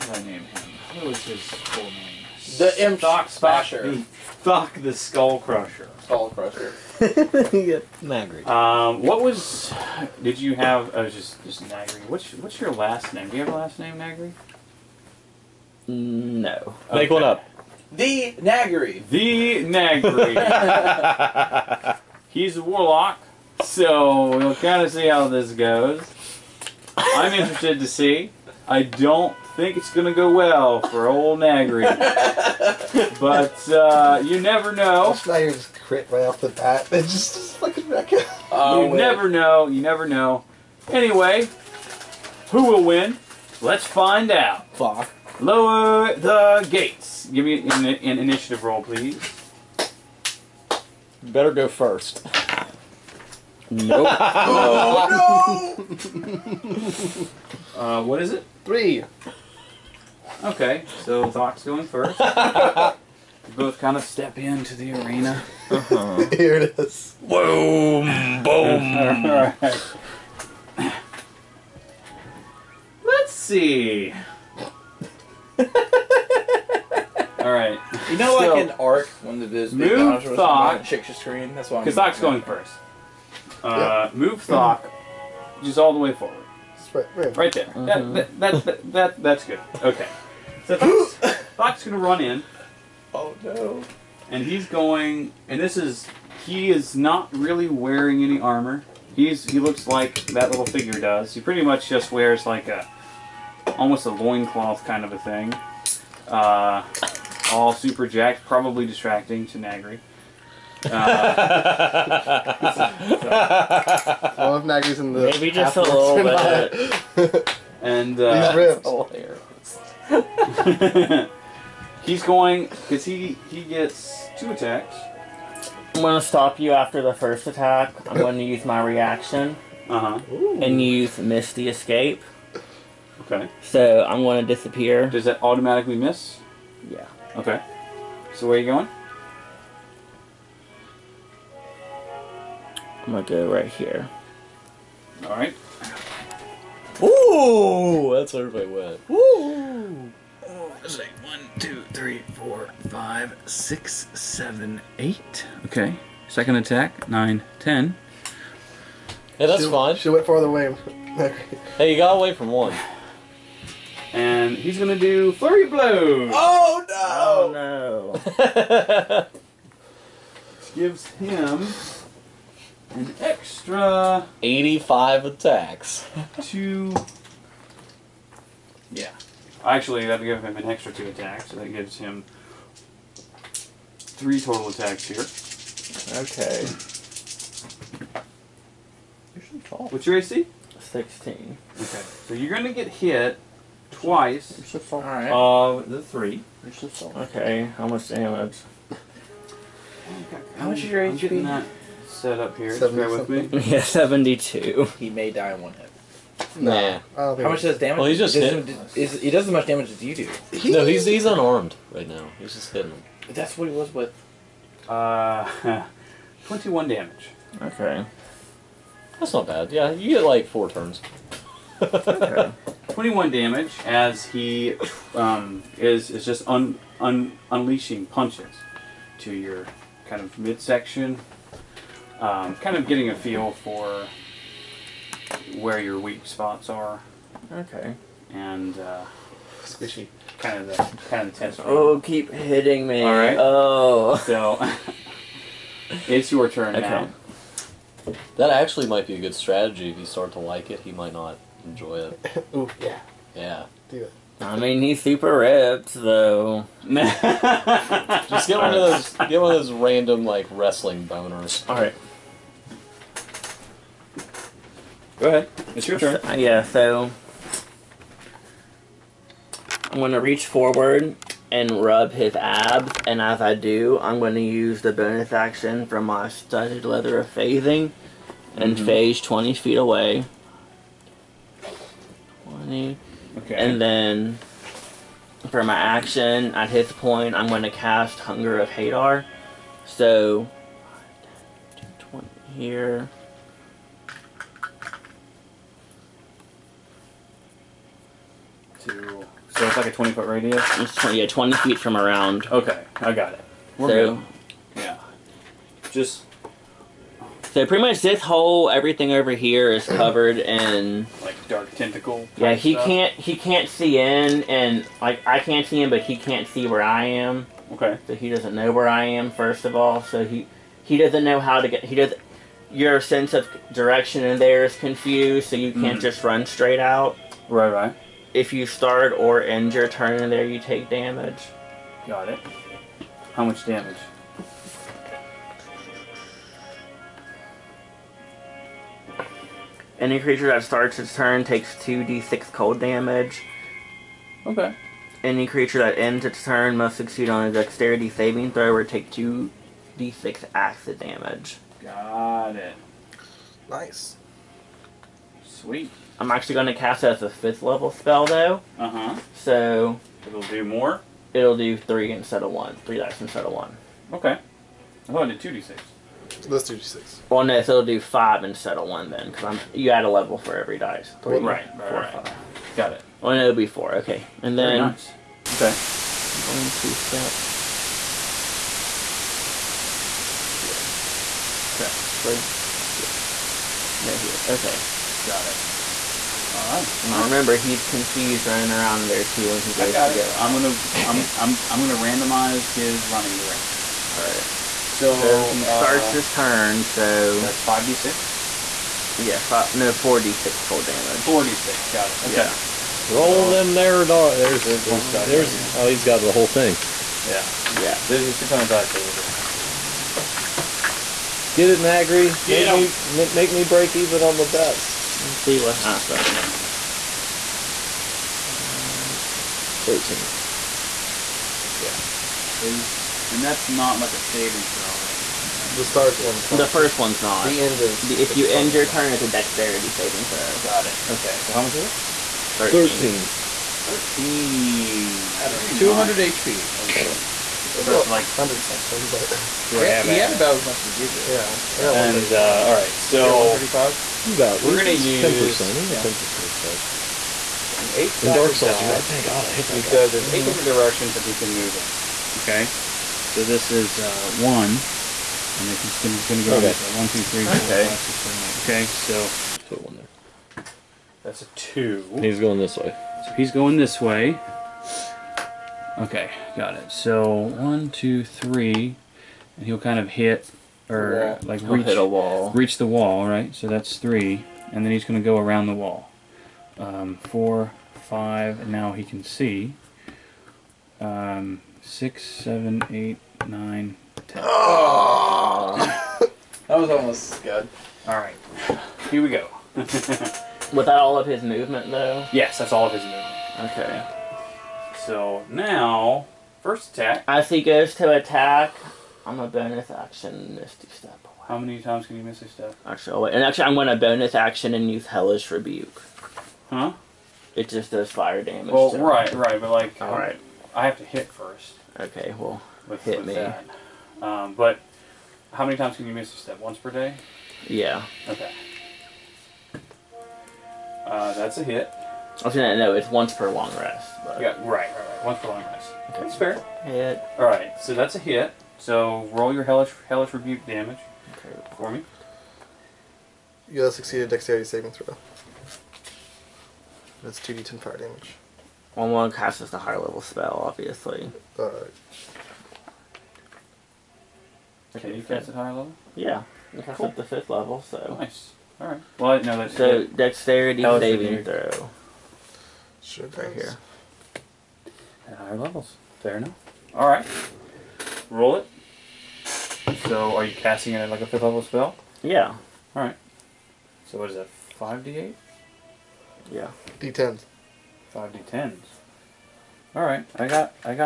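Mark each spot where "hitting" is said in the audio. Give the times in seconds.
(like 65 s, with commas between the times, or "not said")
212 s, 242 s.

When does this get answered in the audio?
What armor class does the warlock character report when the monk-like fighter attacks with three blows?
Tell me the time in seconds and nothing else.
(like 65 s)
190 s.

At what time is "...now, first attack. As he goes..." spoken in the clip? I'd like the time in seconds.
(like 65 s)
495 s.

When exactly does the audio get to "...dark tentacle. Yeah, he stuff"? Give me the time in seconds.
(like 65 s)
311 s.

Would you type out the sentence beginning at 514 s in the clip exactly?
Um, but how many times can you miss a step?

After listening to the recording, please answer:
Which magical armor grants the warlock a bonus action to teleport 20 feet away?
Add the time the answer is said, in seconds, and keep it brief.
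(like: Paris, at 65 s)
studded leather of phasing, at 276 s.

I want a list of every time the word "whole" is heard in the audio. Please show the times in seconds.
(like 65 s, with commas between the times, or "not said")
308 s, 406 s.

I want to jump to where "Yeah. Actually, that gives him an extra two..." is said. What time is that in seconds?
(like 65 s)
178 s.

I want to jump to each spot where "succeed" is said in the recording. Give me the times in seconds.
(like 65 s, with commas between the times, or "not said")
346 s, 533 s.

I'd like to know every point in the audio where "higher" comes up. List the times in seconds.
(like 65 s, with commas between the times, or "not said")
539 s, 545 s, 555 s.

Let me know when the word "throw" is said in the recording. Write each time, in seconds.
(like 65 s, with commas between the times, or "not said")
348 s, 424 s, 430 s, 534 s, 551 s.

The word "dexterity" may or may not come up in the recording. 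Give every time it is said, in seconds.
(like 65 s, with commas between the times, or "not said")
347 s, 429 s, 534 s, 550 s.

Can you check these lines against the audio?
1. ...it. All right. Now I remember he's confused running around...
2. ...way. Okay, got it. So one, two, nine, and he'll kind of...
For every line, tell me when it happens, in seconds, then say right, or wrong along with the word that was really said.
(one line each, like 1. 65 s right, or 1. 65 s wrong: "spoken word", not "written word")
1. 385 s right
2. 464 s wrong: "three", not "nine".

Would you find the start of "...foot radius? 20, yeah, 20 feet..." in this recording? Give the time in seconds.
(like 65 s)
300 s.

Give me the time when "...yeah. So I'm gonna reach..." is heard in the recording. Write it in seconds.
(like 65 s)
266 s.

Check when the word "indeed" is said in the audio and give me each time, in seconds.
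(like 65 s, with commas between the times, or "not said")
not said.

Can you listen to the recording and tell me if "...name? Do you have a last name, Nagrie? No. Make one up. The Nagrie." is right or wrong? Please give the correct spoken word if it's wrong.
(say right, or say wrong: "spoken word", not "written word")
right.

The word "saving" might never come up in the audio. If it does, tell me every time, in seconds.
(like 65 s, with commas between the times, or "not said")
348 s, 424 s, 429 s, 534 s, 550 s.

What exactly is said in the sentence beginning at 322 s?
Your sense of direction in there is confused, so you can't mm.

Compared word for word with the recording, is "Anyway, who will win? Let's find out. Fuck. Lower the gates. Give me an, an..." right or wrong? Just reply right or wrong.
right.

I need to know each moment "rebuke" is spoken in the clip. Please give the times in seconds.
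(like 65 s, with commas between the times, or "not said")
505 s, 530 s.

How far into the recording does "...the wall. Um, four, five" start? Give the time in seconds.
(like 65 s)
475 s.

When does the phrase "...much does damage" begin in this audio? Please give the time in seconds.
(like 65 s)
207 s.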